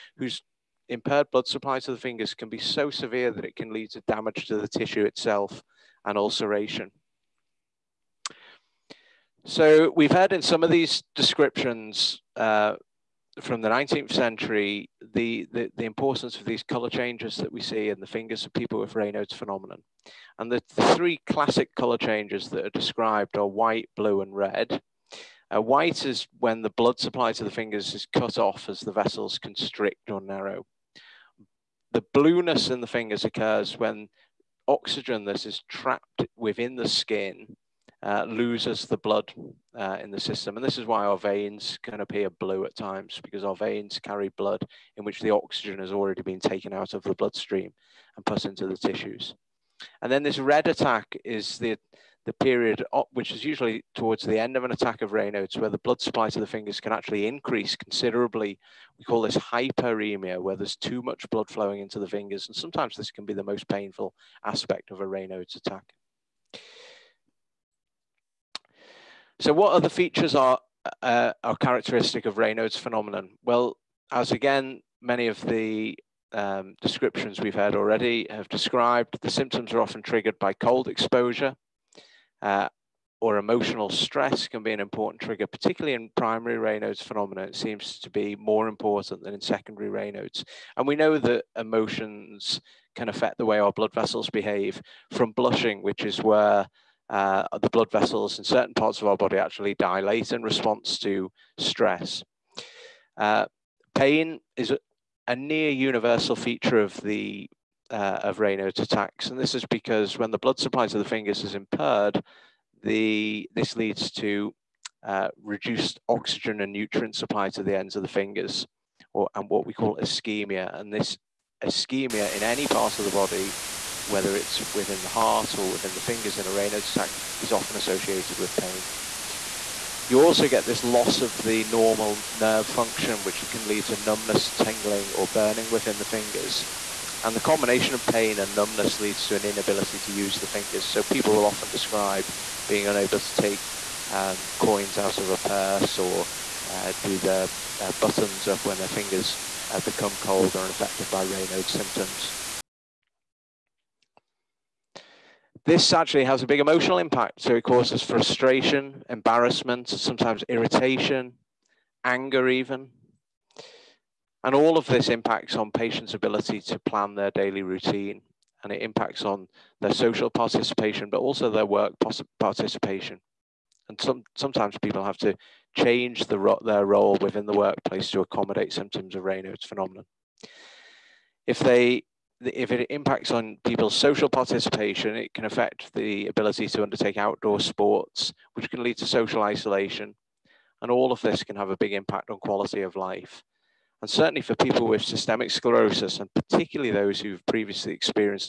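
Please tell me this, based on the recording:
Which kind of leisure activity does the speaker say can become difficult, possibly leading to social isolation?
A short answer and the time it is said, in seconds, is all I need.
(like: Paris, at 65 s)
Outdoor sports, at 187 s.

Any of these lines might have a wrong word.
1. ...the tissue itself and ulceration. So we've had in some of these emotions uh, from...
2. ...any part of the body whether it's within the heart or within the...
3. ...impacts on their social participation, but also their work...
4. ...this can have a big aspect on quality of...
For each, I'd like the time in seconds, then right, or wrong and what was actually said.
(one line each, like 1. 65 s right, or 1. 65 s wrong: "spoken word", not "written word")
1. 4 s wrong: "descriptions", not "emotions"
2. 122 s right
3. 168 s right
4. 191 s wrong: "impact", not "aspect".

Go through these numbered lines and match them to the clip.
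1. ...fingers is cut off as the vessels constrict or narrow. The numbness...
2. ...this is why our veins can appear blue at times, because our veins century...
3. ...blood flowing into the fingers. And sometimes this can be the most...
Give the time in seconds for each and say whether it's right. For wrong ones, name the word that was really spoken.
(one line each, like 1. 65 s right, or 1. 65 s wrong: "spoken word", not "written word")
1. 27 s wrong: "blueness", not "numbness"
2. 40 s wrong: "carry", not "century"
3. 61 s right.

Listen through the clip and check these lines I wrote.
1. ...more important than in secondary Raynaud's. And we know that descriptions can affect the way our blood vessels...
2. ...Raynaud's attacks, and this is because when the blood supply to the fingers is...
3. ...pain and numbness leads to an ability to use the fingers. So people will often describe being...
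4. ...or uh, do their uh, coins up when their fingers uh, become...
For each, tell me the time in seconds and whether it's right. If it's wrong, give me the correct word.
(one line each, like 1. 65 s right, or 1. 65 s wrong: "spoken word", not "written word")
1. 88 s wrong: "emotions", not "descriptions"
2. 108 s right
3. 138 s wrong: "inability", not "ability"
4. 145 s wrong: "buttons", not "coins".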